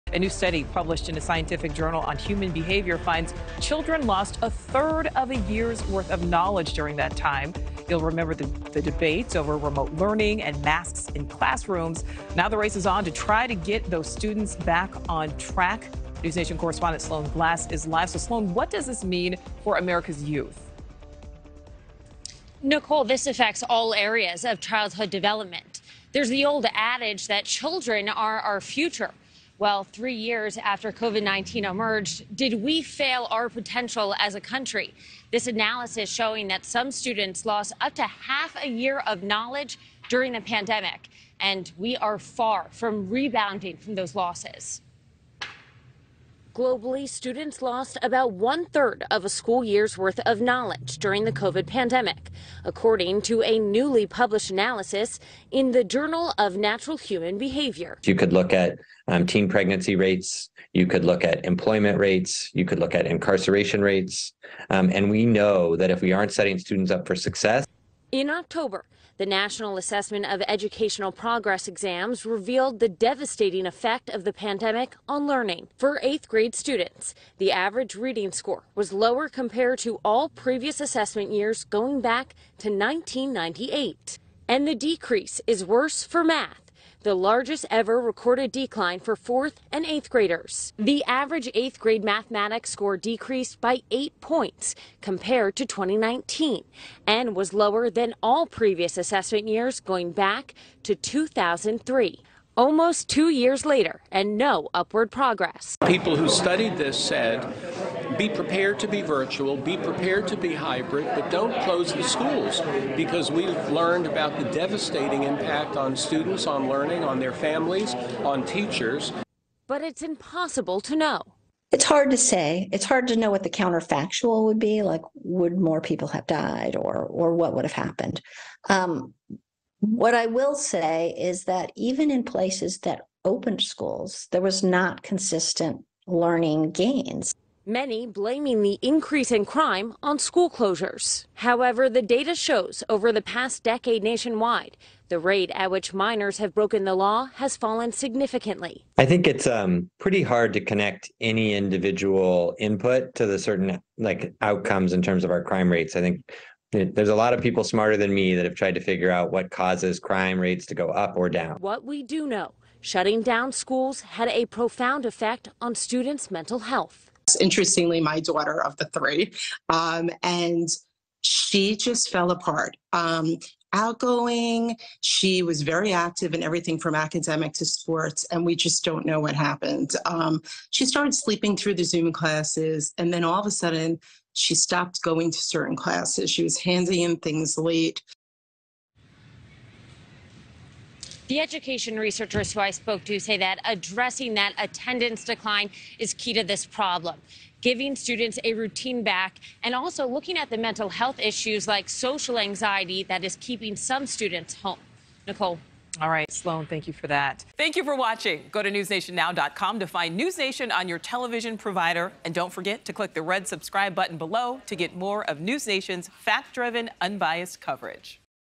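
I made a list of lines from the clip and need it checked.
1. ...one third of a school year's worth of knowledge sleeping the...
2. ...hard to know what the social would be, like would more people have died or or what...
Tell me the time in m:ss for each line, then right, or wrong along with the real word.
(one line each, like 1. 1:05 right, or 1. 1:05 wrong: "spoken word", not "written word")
1. 0:48 wrong: "during", not "sleeping"
2. 2:02 wrong: "counterfactual", not "social".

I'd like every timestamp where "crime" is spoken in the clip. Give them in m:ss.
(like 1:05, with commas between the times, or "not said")
2:19, 2:35, 2:39.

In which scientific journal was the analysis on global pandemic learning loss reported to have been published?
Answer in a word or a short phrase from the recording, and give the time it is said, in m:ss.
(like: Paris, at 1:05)
Nature Human Behavior, at 0:55.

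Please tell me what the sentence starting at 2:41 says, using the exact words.
What we do know, shutting down schools had a profound effect on students' mental health that's interestingly my daughter of the three.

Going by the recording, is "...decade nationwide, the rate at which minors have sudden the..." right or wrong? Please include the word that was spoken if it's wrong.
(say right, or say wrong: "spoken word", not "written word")
wrong: "broken", not "sudden".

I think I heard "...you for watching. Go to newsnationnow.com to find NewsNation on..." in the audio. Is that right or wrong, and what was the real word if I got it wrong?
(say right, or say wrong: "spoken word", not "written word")
right.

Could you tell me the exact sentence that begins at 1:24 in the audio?
And the decrease is worse for math the largest ever recorded decline for fourth and eighth graders.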